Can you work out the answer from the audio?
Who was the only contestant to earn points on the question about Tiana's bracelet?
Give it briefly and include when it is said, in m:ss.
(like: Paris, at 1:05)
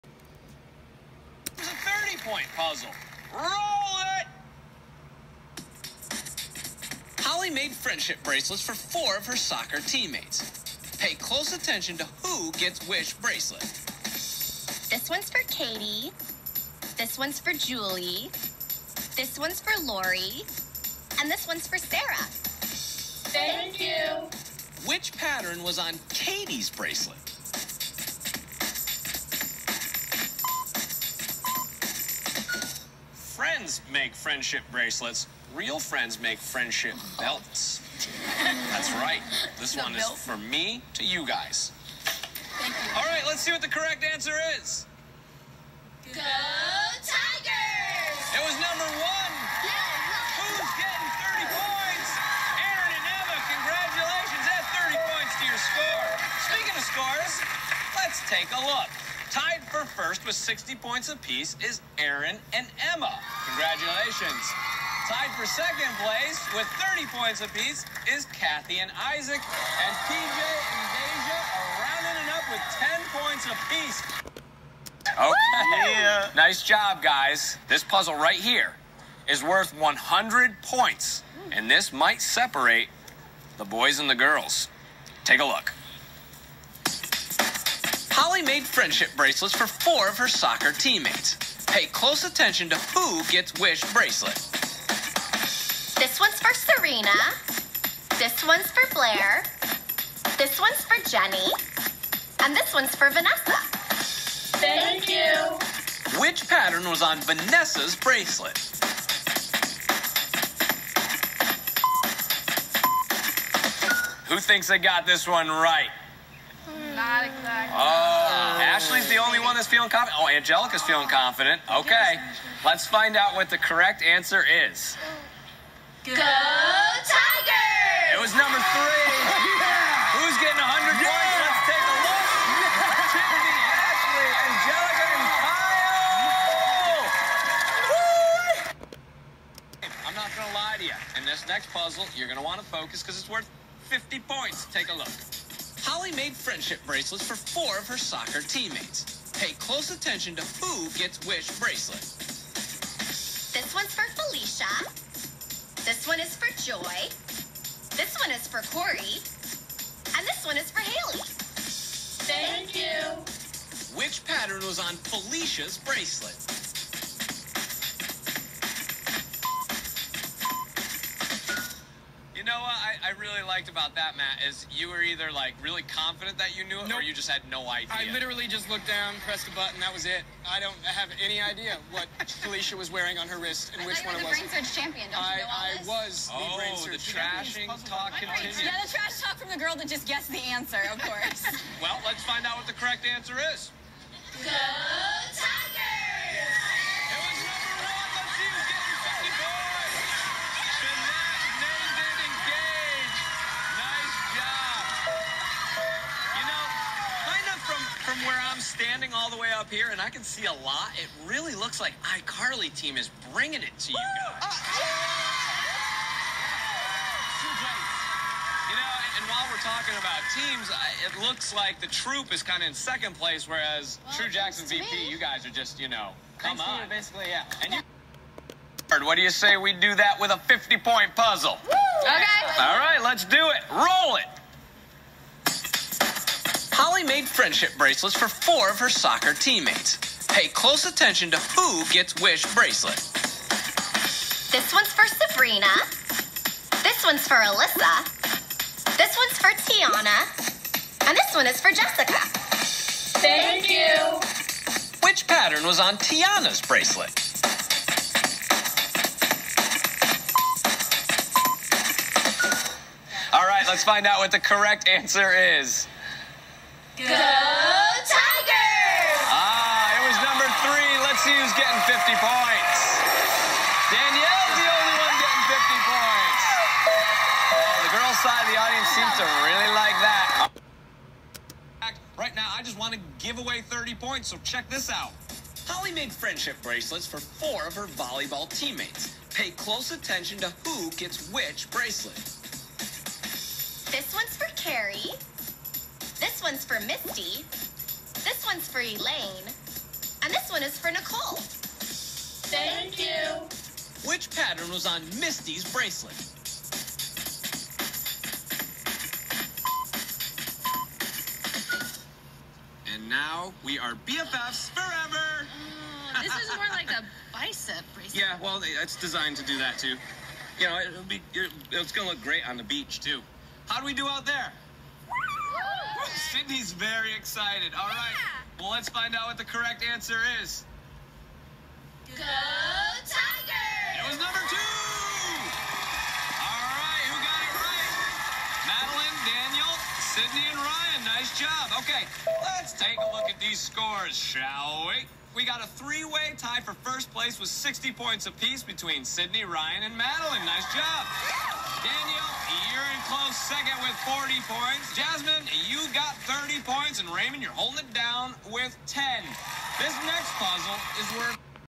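Danielle, at 4:33.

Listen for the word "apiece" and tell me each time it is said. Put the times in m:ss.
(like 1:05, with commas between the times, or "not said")
1:01, 1:07, 1:13, 5:48.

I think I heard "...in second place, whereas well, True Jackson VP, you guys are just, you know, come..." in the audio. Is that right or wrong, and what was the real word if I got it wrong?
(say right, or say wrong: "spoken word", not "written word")
right.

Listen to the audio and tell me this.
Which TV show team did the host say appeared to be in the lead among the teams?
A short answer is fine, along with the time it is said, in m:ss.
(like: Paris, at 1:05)
iCarly, at 3:32.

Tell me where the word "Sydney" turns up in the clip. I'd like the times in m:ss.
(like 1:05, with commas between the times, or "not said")
5:26, 5:40, 5:49.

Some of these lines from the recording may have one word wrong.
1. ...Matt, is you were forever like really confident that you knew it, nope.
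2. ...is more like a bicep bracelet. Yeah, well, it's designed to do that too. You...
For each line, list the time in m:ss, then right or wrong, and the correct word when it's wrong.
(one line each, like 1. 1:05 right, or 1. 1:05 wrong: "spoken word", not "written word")
1. 2:54 wrong: "either", not "forever"
2. 5:16 right.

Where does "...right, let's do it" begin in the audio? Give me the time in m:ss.
3:52.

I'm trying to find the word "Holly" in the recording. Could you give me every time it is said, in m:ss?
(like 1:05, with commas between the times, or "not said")
0:07, 1:28, 2:25, 3:56, 4:45.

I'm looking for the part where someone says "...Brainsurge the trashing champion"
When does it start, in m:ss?
3:06.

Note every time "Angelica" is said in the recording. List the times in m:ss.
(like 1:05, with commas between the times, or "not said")
2:00, 2:20.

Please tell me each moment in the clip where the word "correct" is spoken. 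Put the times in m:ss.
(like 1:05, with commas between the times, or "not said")
0:43, 2:03, 3:12, 4:24, 5:29.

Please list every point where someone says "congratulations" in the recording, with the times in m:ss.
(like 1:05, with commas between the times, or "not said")
0:53, 1:03.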